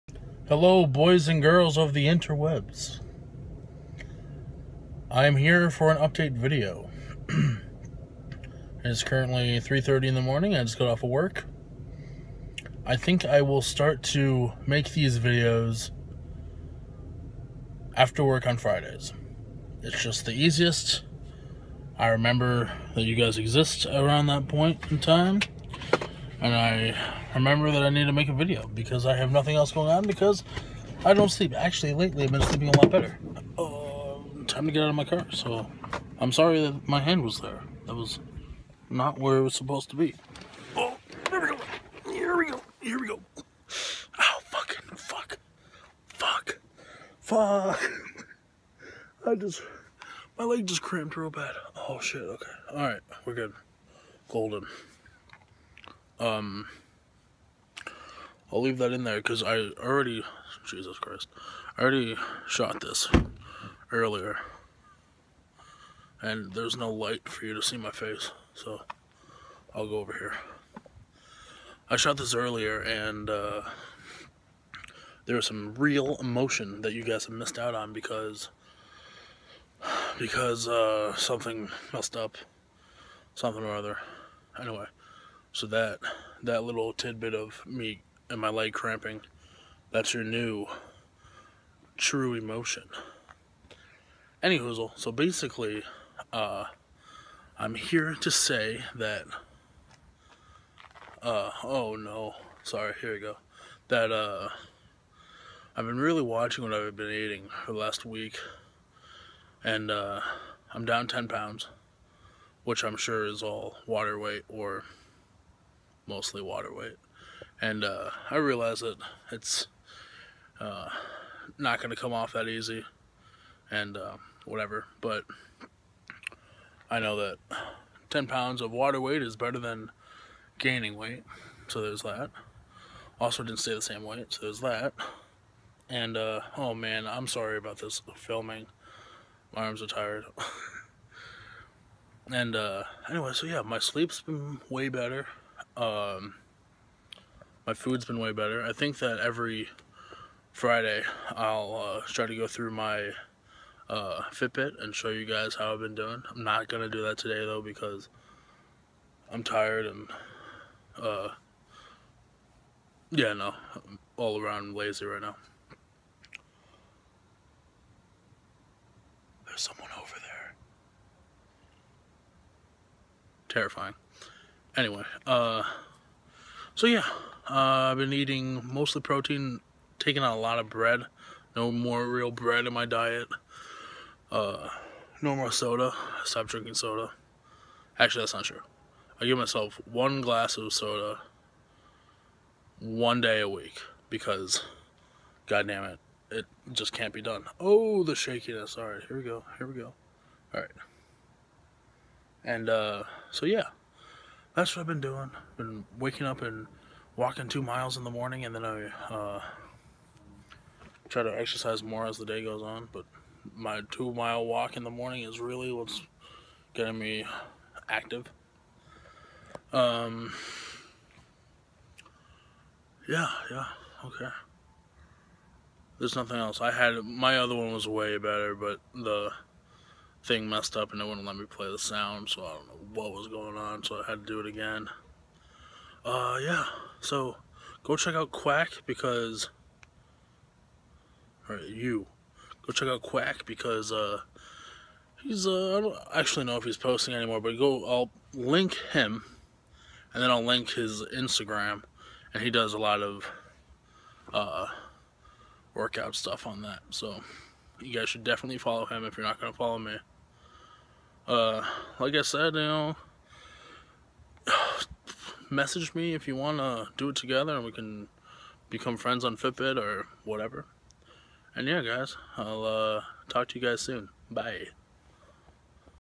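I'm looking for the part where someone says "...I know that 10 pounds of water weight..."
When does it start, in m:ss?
2:06.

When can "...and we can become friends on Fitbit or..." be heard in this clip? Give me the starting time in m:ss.
4:27.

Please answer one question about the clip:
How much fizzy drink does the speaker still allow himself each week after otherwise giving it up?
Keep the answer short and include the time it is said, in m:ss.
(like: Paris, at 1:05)
one glass, at 3:09.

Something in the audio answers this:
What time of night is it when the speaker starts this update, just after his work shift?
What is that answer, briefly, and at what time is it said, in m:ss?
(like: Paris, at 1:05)
3:30, at 0:09.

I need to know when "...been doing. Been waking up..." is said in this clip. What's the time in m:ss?
3:24.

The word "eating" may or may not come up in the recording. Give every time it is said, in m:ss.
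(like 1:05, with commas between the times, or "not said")
1:47, 2:58.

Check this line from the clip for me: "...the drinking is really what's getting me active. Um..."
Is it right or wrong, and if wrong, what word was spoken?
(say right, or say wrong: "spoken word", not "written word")
wrong: "morning", not "drinking".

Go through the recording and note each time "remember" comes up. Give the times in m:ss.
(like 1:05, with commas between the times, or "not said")
0:22, 0:27.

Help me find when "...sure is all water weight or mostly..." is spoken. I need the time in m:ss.
1:52.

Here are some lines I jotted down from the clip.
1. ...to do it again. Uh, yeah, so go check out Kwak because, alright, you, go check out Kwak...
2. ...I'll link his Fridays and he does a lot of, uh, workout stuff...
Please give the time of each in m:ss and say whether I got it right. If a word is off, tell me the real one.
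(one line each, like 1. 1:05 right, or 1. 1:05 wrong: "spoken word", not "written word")
1. 3:54 right
2. 4:10 wrong: "Instagram", not "Fridays".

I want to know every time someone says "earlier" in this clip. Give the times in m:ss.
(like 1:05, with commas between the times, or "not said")
1:03, 1:12.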